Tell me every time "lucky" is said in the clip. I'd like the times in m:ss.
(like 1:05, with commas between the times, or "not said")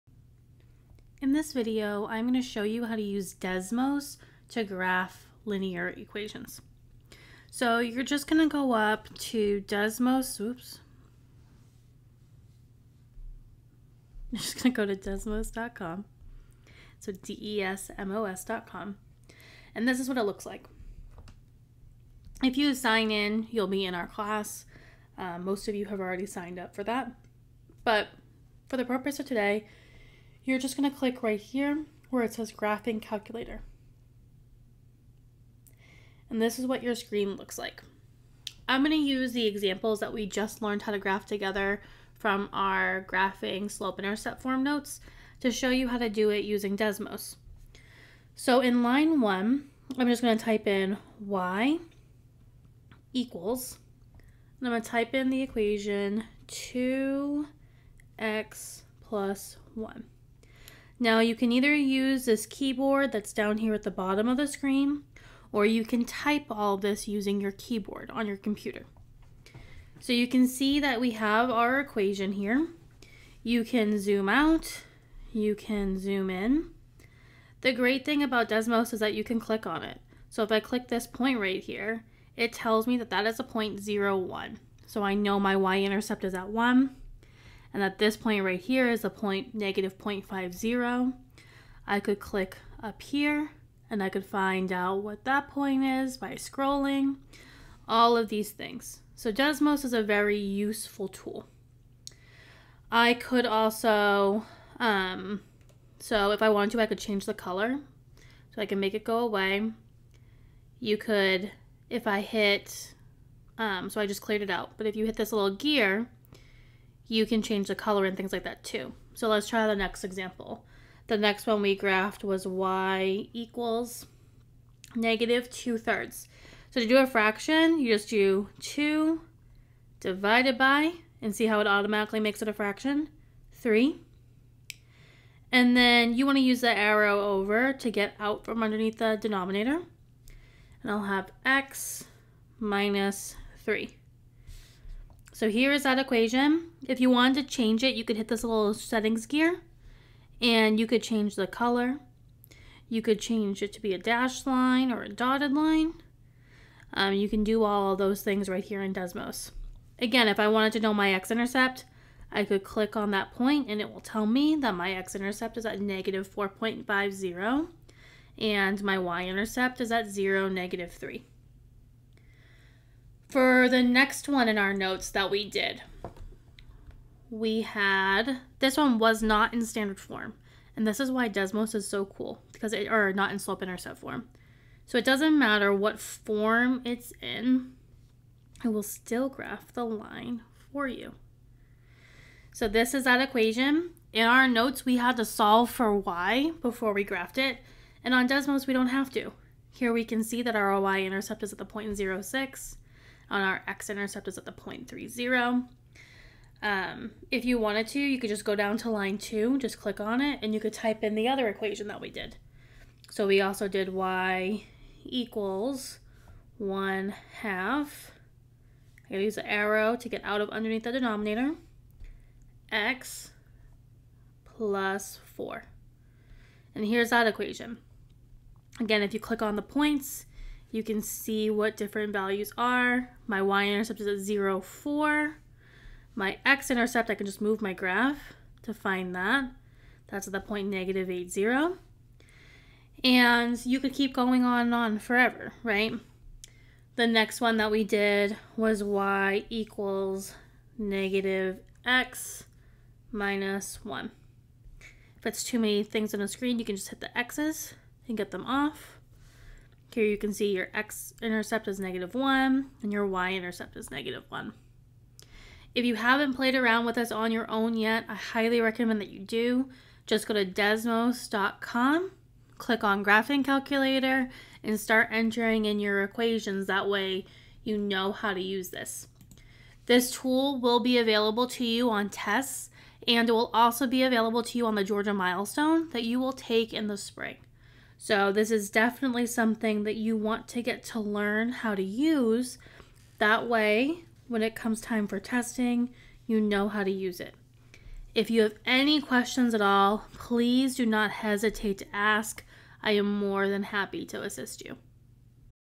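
not said.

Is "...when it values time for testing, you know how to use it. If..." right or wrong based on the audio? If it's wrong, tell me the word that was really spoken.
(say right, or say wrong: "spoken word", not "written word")
wrong: "comes", not "values".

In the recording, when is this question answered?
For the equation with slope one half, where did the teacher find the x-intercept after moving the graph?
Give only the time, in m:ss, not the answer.
4:00.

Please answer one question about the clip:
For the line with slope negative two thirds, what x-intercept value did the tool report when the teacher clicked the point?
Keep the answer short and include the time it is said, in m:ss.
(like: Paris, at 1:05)
-4.50, at 2:45.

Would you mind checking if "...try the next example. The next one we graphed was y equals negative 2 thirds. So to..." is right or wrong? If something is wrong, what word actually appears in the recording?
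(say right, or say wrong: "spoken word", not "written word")
right.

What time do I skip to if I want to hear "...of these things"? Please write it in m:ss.
1:38.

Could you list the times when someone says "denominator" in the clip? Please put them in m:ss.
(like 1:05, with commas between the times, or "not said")
2:19, 3:40.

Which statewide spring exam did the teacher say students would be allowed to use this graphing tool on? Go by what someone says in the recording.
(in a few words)
Georgia Milestone.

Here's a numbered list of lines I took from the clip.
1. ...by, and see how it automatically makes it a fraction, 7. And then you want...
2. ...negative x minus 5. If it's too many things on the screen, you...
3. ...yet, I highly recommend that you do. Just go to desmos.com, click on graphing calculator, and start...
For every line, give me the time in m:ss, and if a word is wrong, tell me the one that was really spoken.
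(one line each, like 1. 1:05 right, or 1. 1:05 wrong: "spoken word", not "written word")
1. 2:10 wrong: "3", not "7"
2. 4:10 wrong: "1", not "5"
3. 4:27 right.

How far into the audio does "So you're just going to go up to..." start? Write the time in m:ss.
0:07.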